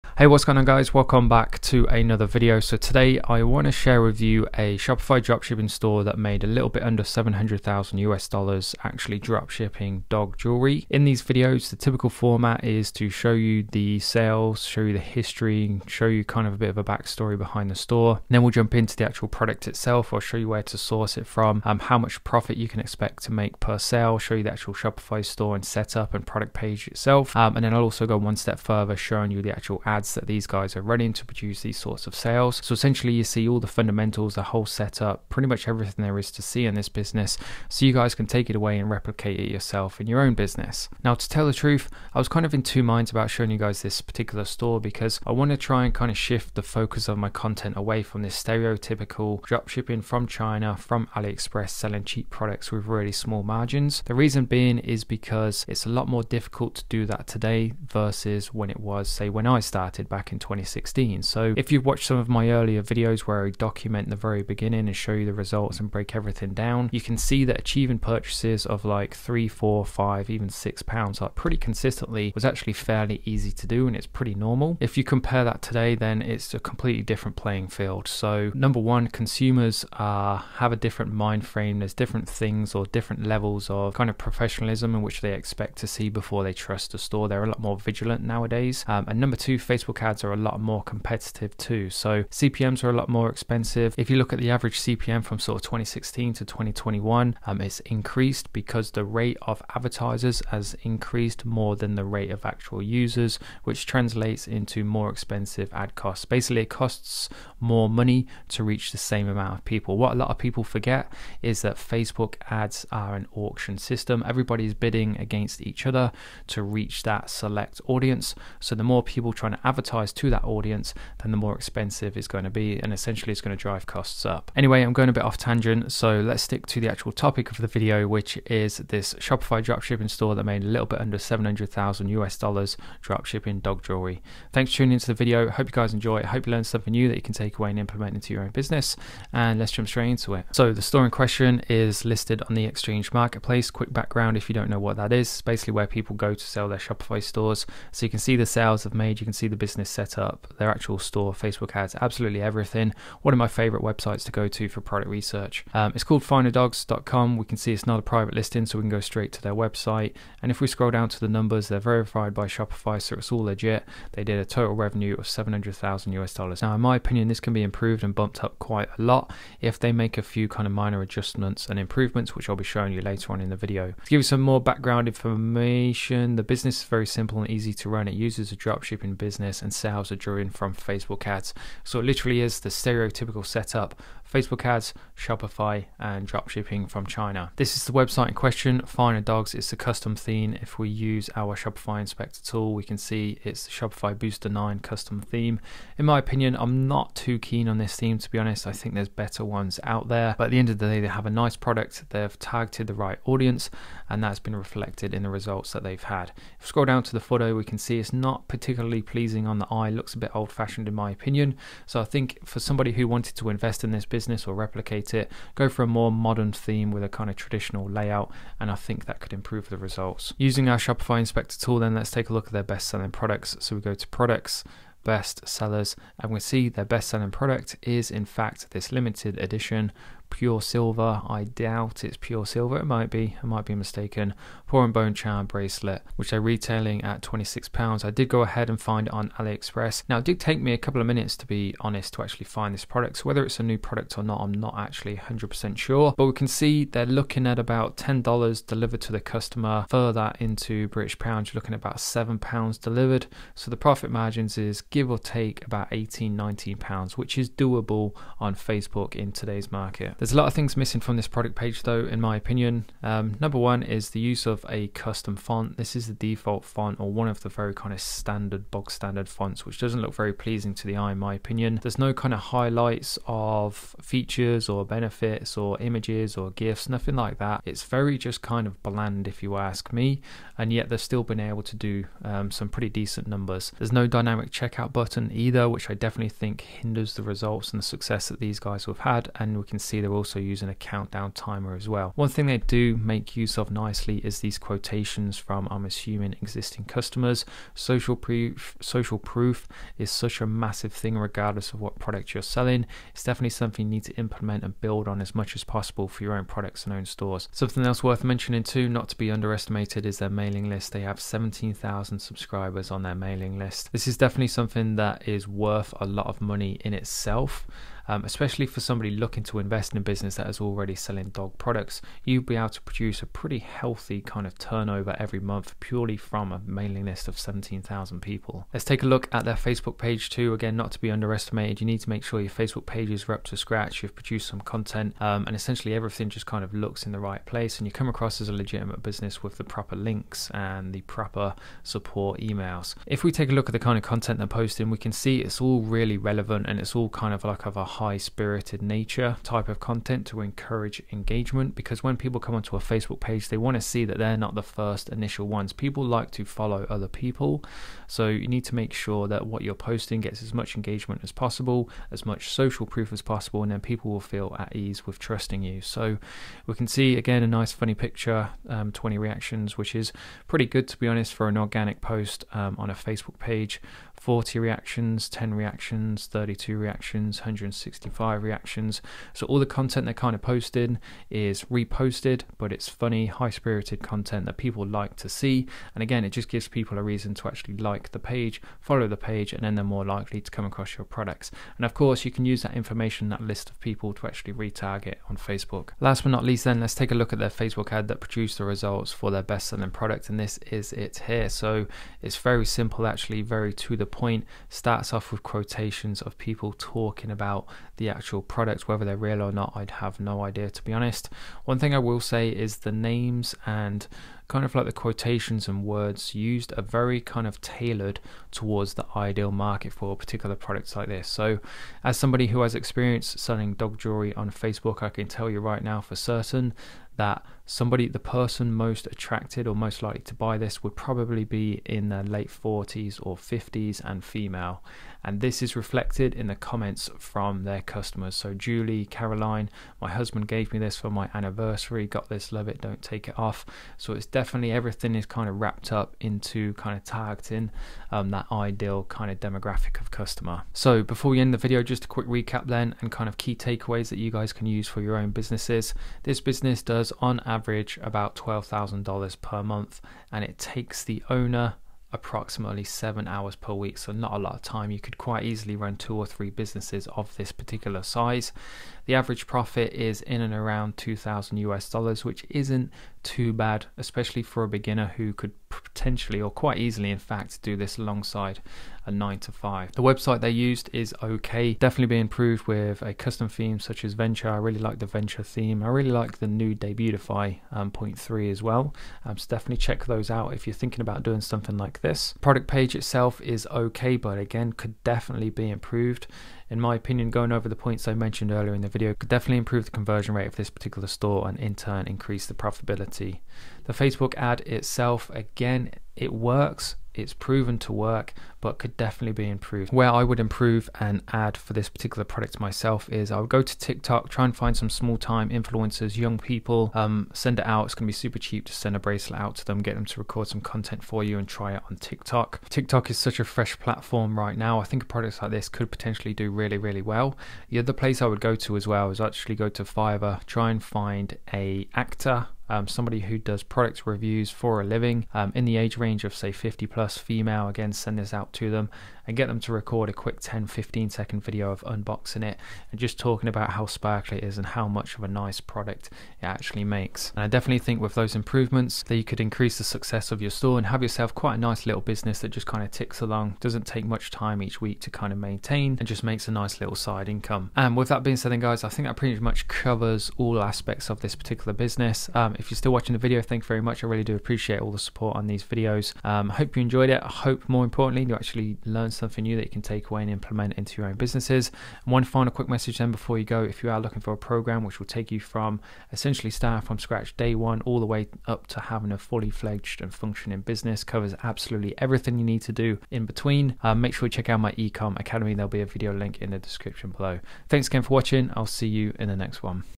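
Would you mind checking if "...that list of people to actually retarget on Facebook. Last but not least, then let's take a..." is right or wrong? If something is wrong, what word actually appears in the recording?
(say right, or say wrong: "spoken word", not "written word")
right.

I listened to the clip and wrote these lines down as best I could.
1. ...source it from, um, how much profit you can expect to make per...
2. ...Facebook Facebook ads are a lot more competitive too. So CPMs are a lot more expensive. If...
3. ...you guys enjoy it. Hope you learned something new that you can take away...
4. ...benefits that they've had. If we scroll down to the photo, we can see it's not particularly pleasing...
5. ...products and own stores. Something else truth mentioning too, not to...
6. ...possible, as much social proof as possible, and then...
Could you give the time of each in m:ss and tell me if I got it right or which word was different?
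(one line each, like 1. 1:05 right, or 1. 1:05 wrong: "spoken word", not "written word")
1. 0:20 right
2. 1:29 right
3. 2:15 right
4. 3:25 wrong: "results", not "benefits"
5. 5:06 wrong: "worth", not "truth"
6. 6:01 right.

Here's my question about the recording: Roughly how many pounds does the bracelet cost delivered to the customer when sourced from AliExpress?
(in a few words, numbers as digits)
£7.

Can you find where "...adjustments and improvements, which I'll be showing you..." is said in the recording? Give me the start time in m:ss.
2:51.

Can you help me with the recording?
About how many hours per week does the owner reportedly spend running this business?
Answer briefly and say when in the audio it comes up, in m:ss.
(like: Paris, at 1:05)
7 hours, at 7:42.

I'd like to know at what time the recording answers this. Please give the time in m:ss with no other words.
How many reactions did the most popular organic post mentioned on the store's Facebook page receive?
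6:17.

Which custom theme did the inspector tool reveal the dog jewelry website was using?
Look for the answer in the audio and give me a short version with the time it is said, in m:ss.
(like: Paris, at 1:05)
Shopify Booster 9, at 3:13.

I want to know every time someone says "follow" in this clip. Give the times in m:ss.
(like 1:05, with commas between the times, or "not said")
5:56, 6:28.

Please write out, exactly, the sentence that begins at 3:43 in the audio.
So we go to products best sellers and we see their best selling product is in fact this limited edition pure silver.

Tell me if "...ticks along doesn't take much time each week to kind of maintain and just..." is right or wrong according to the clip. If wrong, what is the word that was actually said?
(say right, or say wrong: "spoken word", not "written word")
right.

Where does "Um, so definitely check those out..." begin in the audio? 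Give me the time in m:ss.
8:09.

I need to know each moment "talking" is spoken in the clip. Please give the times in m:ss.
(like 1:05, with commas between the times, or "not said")
6:46, 9:03.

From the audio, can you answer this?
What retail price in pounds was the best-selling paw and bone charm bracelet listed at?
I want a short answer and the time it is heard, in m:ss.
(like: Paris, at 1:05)
£26, at 3:57.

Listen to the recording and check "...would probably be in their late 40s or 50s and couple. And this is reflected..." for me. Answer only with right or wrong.
wrong.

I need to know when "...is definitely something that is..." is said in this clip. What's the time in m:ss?
5:14.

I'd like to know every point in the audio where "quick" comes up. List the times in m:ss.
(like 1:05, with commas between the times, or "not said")
2:23, 7:32, 9:00, 9:32.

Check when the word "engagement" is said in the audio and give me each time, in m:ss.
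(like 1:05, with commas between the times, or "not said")
5:51, 6:00.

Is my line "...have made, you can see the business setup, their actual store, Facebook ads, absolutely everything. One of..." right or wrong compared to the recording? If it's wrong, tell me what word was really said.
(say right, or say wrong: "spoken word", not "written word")
right.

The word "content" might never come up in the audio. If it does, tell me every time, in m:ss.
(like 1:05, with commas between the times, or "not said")
0:47, 5:34, 5:44, 5:49, 6:19, 6:24, 8:40.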